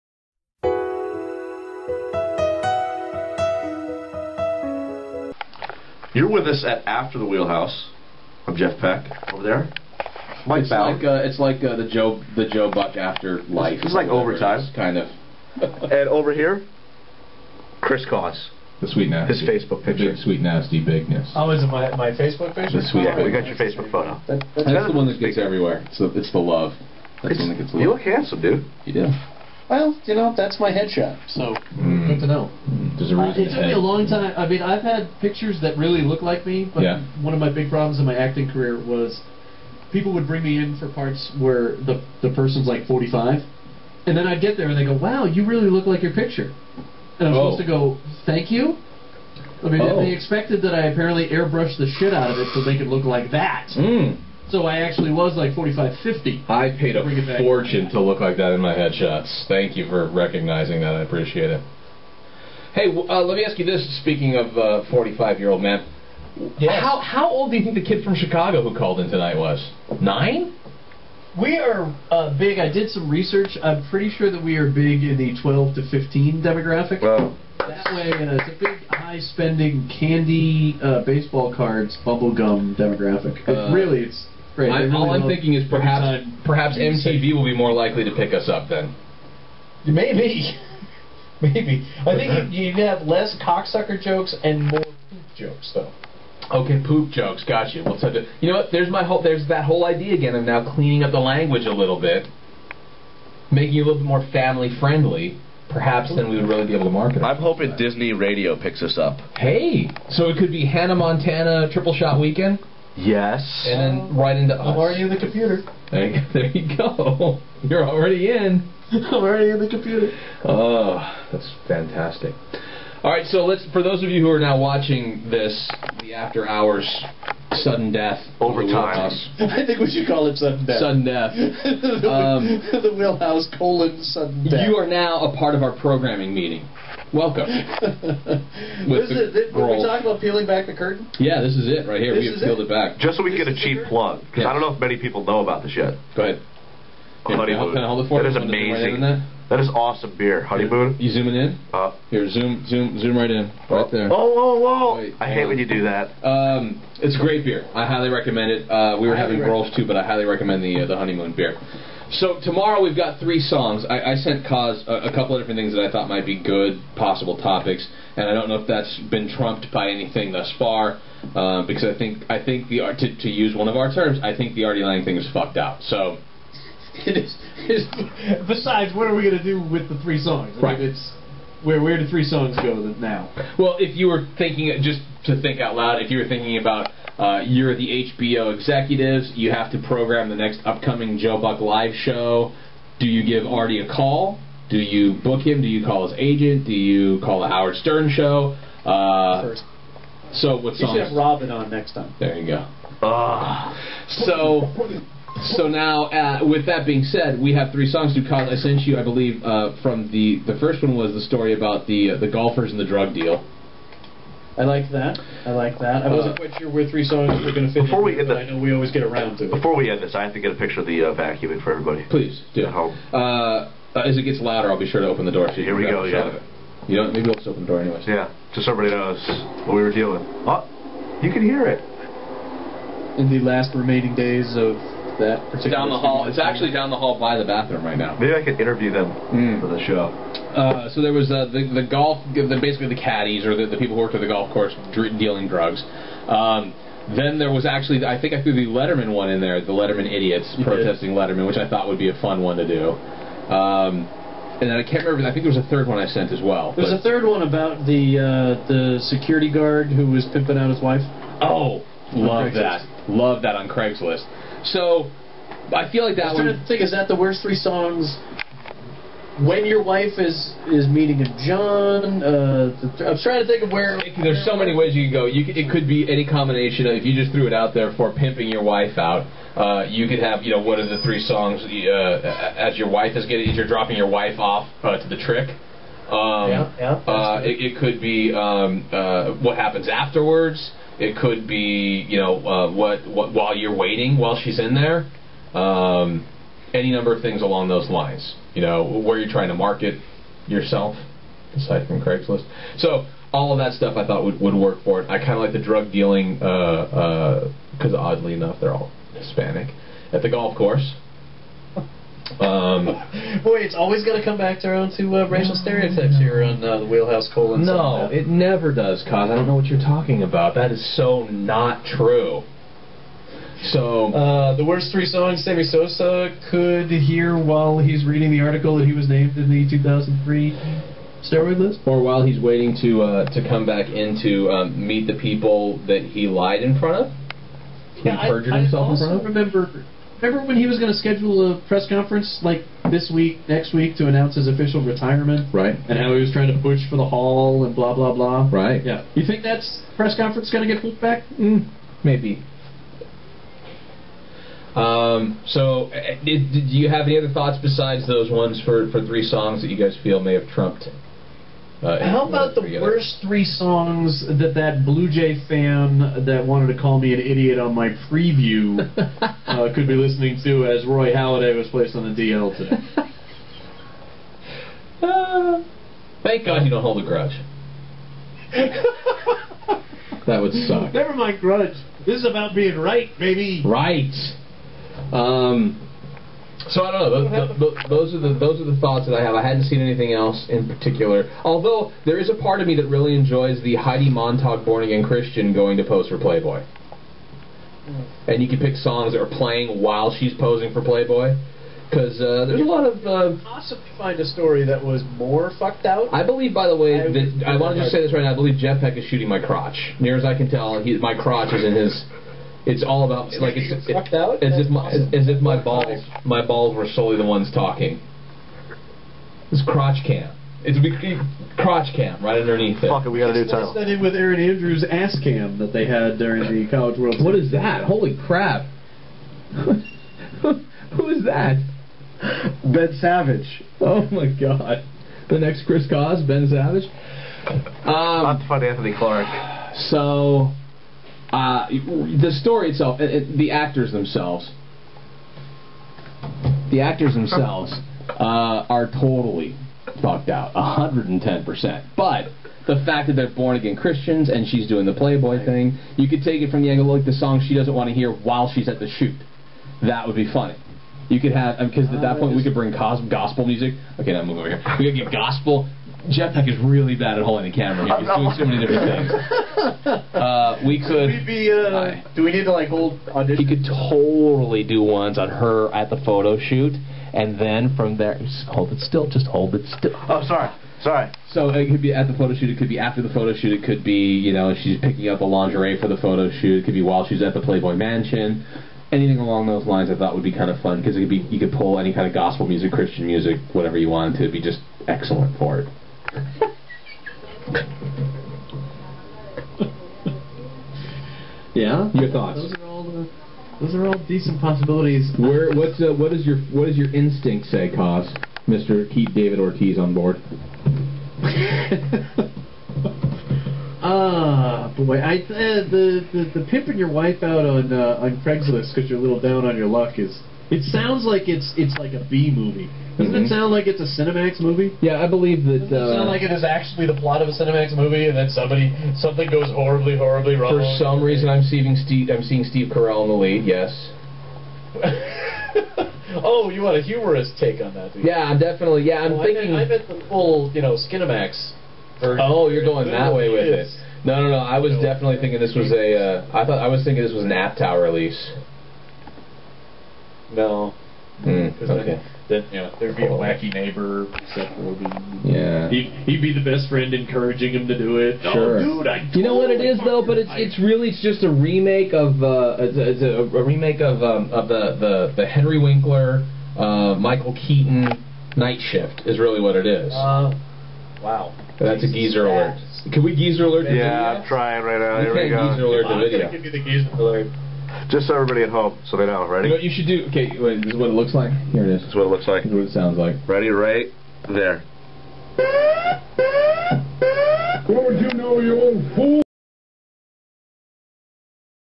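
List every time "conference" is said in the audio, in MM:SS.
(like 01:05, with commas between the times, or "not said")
05:41, 05:50.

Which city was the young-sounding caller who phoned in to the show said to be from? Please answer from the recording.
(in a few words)
Chicago.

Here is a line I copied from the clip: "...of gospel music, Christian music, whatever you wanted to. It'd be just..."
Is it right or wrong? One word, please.
right.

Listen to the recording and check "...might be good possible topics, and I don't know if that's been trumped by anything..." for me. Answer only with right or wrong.
right.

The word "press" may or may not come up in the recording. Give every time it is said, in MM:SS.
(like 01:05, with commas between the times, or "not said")
05:41, 05:49.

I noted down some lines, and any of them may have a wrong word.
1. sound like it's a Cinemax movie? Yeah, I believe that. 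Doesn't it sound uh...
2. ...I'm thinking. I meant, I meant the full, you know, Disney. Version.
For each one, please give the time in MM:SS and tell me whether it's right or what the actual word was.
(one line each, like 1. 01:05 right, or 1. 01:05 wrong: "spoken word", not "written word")
1. 08:43 right
2. 08:59 wrong: "Cinemax", not "Disney".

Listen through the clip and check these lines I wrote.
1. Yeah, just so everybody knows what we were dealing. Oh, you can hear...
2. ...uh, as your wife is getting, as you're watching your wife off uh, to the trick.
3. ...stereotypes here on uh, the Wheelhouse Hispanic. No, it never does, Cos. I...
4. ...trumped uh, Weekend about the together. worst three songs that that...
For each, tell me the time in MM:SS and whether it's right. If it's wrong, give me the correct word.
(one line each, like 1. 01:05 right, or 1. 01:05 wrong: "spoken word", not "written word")
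1. 03:48 right
2. 04:41 wrong: "dropping", not "watching"
3. 05:15 wrong: "Colon", not "Hispanic"
4. 06:00 wrong: "How", not "Weekend".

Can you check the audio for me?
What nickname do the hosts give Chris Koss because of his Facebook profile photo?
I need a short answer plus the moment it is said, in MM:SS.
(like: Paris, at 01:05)
The sweet nasty, at 00:18.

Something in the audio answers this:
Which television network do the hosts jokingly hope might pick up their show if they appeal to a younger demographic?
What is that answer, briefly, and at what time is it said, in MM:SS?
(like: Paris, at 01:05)
MTV, at 01:26.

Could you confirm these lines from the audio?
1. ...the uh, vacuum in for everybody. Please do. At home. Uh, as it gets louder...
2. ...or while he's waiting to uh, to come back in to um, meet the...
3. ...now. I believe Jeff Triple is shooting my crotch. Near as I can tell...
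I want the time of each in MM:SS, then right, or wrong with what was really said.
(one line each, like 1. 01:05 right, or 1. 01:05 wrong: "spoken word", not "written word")
1. 03:40 right
2. 05:31 right
3. 06:48 wrong: "Peck", not "Triple".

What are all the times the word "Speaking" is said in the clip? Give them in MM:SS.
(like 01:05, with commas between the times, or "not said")
01:04.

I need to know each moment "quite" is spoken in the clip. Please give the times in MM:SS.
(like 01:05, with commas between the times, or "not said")
03:36.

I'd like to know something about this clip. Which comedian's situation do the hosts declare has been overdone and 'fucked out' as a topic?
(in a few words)
Artie Lange.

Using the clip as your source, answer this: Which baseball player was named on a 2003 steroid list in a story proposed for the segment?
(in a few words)
Sammy Sosa.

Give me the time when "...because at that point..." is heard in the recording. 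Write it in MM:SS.
07:41.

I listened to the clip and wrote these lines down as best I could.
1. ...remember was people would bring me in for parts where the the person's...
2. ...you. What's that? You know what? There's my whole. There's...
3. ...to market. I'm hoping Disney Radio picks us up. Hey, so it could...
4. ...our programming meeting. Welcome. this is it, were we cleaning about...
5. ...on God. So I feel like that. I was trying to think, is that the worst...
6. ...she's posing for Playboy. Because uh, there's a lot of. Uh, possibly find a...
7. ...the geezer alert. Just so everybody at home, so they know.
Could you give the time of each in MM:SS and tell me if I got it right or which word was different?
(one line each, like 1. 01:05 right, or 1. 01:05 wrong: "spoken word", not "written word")
1. 00:38 wrong: "career", not "remember"
2. 01:37 right
3. 01:46 right
4. 02:15 wrong: "talking", not "cleaning"
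5. 04:23 wrong: "Craigslist", not "God"
6. 06:40 right
7. 09:36 right.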